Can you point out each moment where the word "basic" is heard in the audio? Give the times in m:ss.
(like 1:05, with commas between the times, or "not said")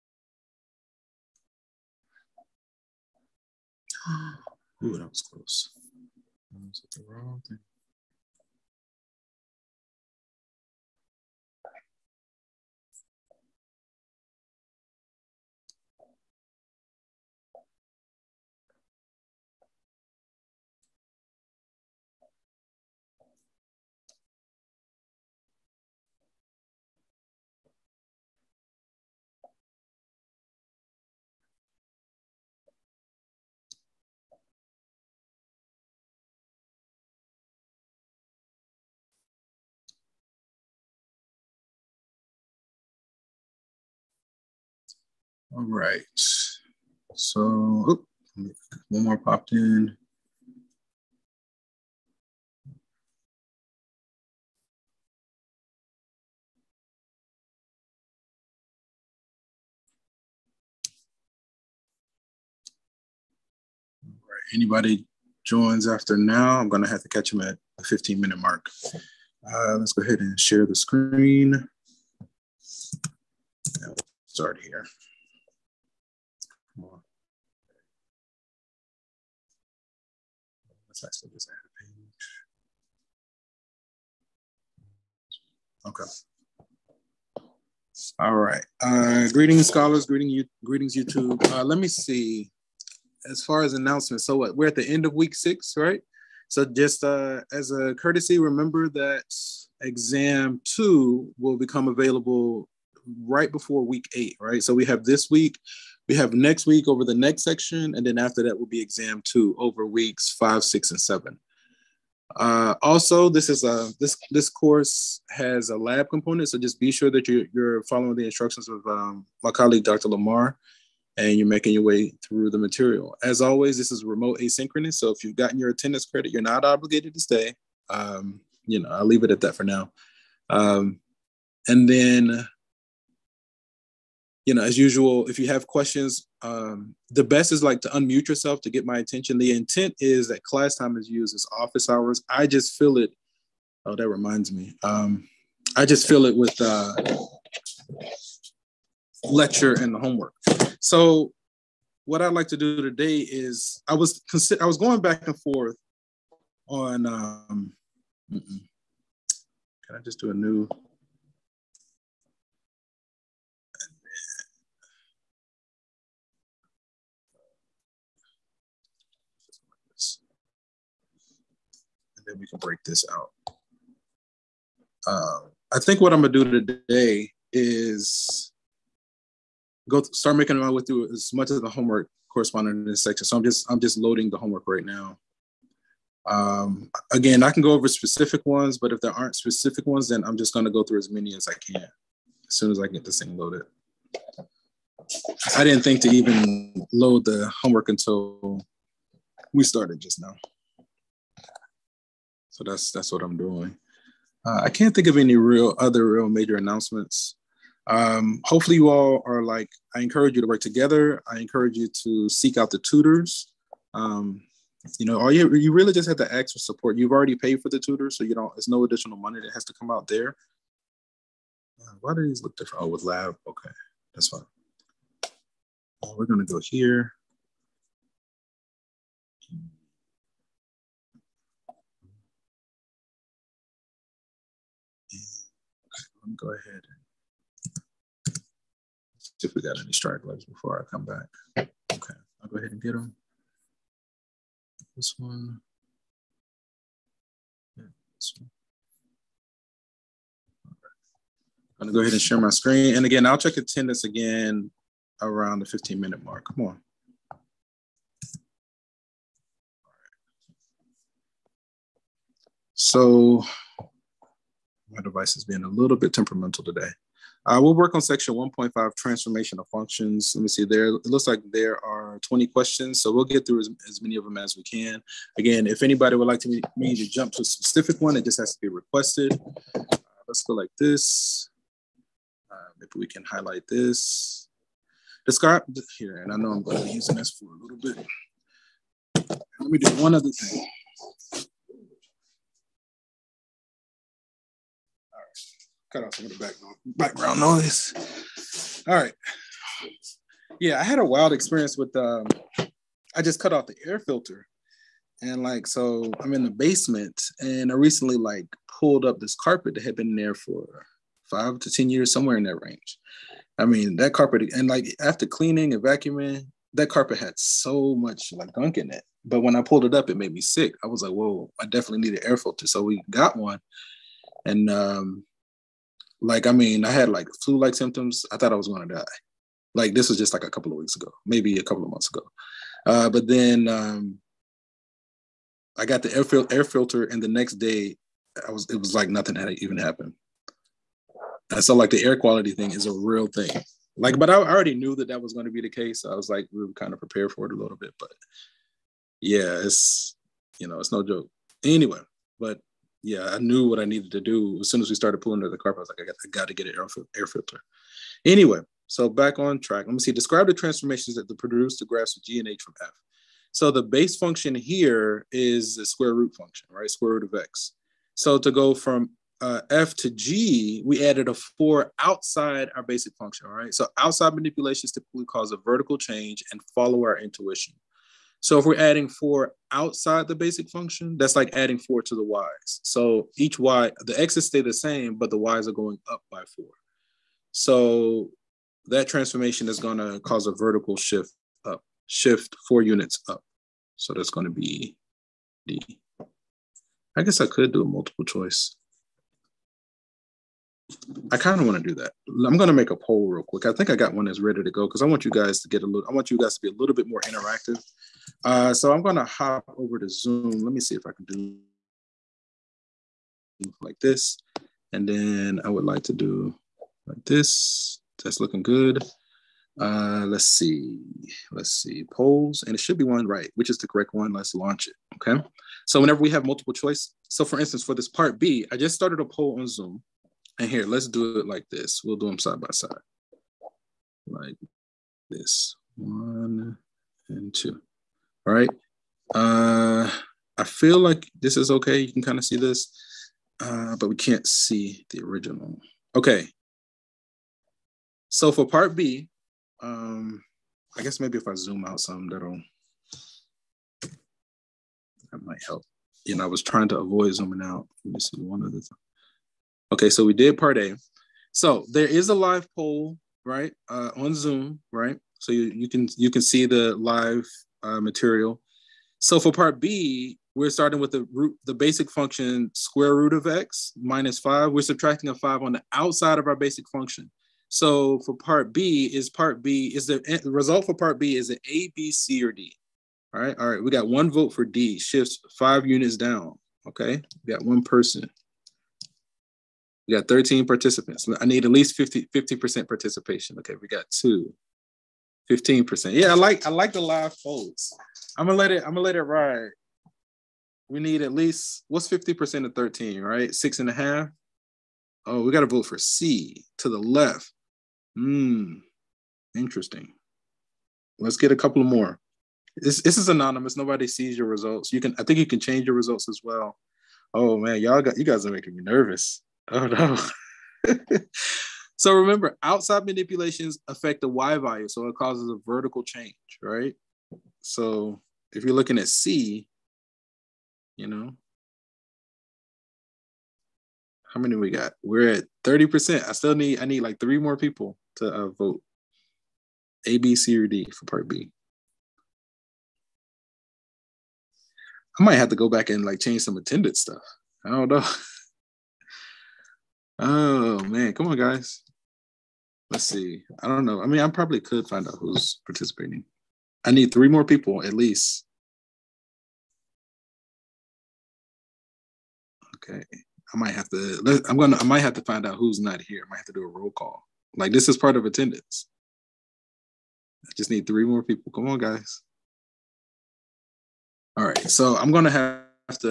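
6:12, 6:20, 7:51, 7:56.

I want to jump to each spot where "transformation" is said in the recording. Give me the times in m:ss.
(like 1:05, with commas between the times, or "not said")
4:28, 6:00, 6:29.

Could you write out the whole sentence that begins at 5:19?
But when I pulled it up, it made me sick.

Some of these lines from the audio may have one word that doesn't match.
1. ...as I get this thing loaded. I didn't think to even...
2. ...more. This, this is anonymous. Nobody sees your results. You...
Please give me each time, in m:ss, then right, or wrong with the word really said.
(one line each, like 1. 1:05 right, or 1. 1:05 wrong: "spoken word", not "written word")
1. 3:12 right
2. 8:31 right.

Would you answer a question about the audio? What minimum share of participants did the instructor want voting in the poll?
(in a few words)
50%.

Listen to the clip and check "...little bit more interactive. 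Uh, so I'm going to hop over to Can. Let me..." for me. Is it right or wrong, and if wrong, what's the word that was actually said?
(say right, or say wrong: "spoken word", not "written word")
wrong: "Zoom", not "Can".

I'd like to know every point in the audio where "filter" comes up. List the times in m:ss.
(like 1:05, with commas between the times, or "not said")
5:04, 5:22, 5:36, 5:57.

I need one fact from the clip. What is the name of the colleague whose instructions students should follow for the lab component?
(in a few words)
Dr. Lamar.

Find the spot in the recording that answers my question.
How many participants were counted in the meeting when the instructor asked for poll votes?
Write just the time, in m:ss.
8:10.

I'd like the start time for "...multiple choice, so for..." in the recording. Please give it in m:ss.
7:06.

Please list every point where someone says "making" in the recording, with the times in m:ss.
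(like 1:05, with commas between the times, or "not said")
2:01, 3:00, 8:38.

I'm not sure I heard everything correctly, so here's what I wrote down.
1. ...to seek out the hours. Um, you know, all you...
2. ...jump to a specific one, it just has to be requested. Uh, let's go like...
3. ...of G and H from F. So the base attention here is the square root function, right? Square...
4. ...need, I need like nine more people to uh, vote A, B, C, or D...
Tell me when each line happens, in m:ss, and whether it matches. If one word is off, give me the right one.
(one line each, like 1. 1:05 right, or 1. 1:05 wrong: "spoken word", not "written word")
1. 3:32 wrong: "tutors", not "hours"
2. 4:37 right
3. 6:02 wrong: "function", not "attention"
4. 8:56 wrong: "three", not "nine".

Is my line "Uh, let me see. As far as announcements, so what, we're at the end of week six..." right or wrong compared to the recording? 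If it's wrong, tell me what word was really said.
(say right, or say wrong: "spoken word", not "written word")
right.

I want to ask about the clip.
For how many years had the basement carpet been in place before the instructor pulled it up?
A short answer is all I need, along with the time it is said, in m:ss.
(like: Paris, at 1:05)
5 to 10 years, at 5:11.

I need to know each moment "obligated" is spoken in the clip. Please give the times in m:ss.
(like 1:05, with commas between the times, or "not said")
2:06.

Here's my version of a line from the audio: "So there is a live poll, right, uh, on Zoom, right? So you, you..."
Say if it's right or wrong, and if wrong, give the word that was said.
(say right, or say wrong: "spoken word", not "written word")
right.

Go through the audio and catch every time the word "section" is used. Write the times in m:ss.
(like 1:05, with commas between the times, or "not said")
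1:47, 3:03, 4:28.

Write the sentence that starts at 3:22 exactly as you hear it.
So that's that's what I'm doing.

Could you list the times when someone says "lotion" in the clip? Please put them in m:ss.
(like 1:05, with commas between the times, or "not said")
not said.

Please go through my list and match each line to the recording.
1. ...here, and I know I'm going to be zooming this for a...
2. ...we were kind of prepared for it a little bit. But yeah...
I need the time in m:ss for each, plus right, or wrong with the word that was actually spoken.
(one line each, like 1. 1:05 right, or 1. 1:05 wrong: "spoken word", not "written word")
1. 4:45 wrong: "using", not "zooming"
2. 5:46 right.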